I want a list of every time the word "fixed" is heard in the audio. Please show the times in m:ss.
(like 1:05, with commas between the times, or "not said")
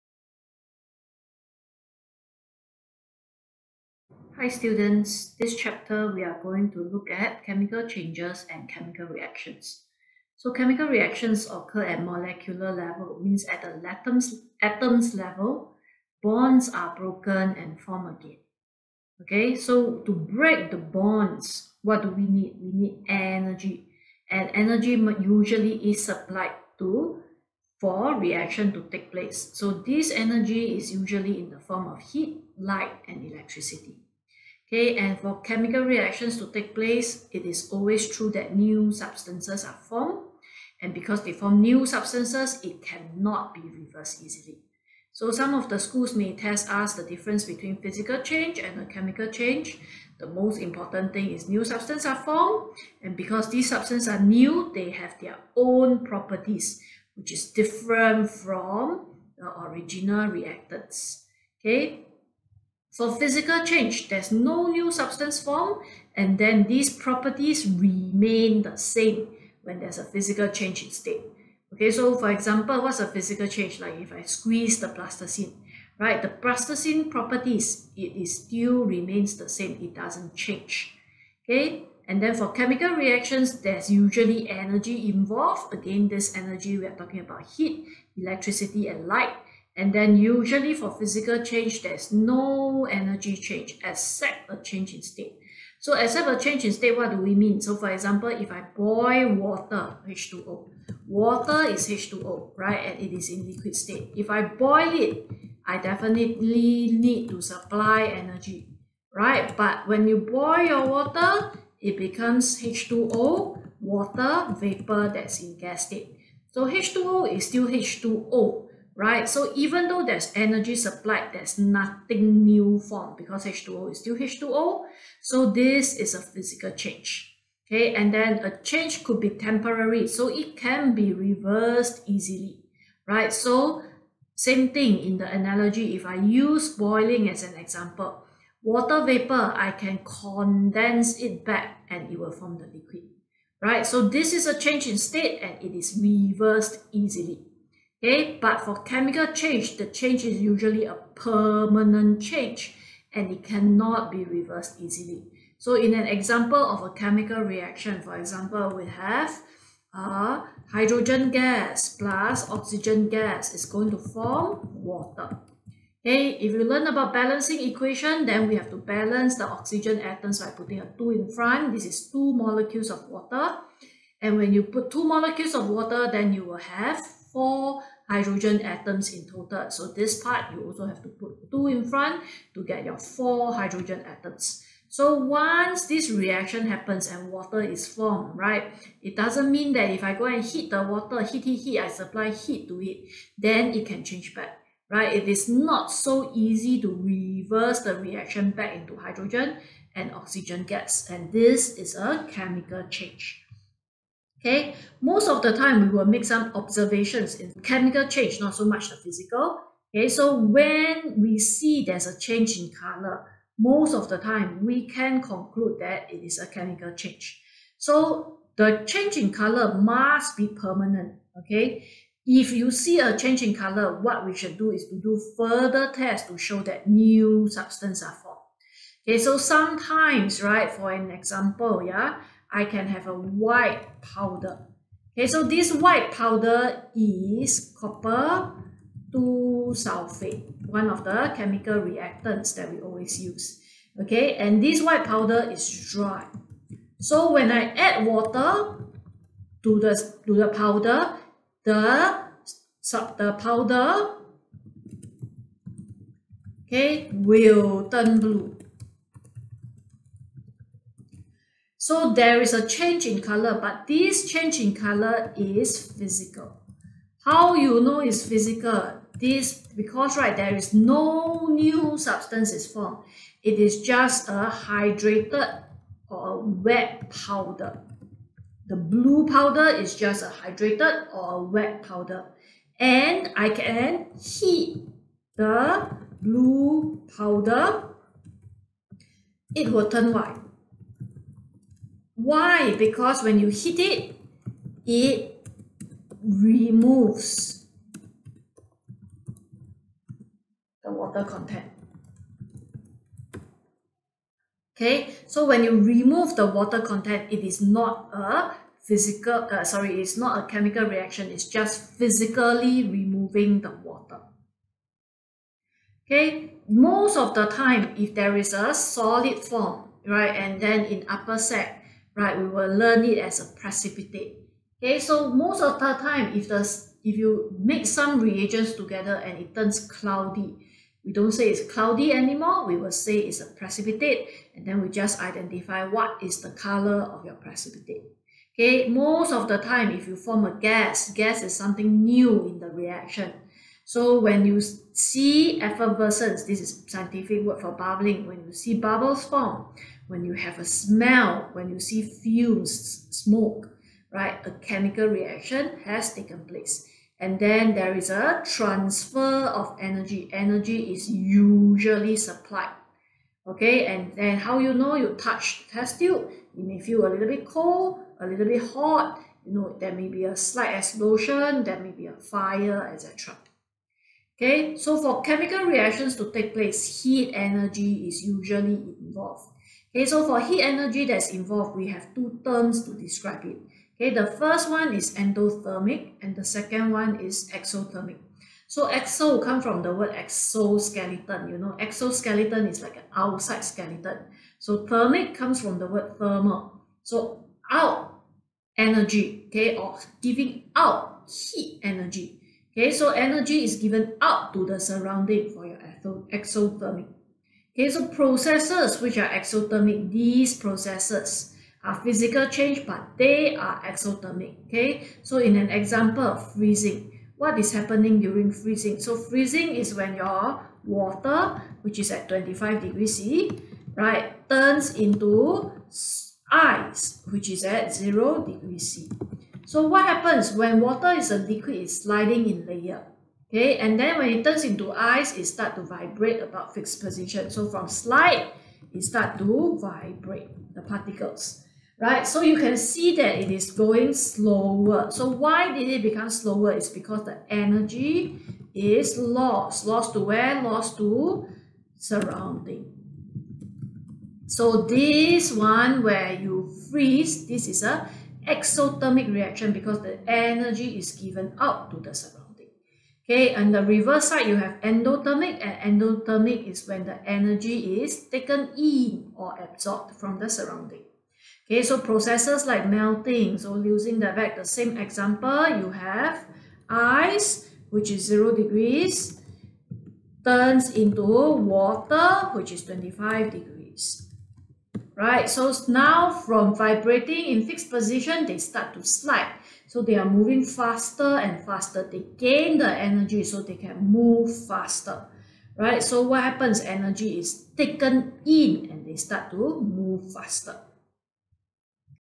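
7:16, 8:07.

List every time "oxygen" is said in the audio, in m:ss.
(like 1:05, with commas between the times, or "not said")
2:42, 2:49, 3:20.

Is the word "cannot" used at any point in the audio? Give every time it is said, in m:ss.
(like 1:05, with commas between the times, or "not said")
0:42, 2:33.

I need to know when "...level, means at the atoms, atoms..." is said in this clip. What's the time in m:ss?
0:12.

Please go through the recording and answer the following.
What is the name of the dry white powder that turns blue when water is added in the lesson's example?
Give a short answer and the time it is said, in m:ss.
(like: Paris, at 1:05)
copper 2 sulfate, at 3:57.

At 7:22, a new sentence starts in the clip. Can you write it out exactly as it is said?
So you can see that it is going slower.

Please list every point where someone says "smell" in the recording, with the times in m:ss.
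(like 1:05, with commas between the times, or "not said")
5:50.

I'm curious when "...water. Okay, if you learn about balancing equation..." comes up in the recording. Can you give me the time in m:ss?
2:44.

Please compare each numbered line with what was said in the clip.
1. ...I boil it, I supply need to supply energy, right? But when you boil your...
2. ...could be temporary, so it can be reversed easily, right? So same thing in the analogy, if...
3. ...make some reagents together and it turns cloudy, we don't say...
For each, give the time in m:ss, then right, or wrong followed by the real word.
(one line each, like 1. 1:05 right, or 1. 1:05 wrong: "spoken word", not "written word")
1. 1:44 wrong: "definitely", not "supply"
2. 2:09 right
3. 5:27 right.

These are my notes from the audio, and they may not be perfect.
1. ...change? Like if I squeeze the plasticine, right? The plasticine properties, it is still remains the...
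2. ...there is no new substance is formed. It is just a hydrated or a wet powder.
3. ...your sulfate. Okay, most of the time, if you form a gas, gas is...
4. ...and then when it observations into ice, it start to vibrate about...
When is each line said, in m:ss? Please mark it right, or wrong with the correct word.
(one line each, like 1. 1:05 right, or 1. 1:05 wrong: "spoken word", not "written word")
1. 1:13 right
2. 4:30 right
3. 5:37 wrong: "precipitate", not "sulfate"
4. 7:13 wrong: "turns", not "observations".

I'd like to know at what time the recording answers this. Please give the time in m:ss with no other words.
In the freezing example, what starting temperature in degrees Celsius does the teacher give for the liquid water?
7:02.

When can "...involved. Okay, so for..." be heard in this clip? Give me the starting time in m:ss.
6:18.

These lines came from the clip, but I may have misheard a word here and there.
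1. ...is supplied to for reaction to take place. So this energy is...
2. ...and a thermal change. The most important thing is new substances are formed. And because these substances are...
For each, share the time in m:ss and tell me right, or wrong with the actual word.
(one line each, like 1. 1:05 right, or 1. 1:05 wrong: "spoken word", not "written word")
1. 0:25 right
2. 0:48 wrong: "chemical", not "thermal".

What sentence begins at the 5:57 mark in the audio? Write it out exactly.
And then there is a transfer of energy.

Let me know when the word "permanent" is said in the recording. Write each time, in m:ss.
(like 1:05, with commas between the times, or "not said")
2:31, 3:40.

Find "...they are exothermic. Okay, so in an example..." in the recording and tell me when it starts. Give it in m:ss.
6:53.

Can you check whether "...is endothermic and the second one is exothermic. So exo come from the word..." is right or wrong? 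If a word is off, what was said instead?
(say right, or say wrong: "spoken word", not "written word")
right.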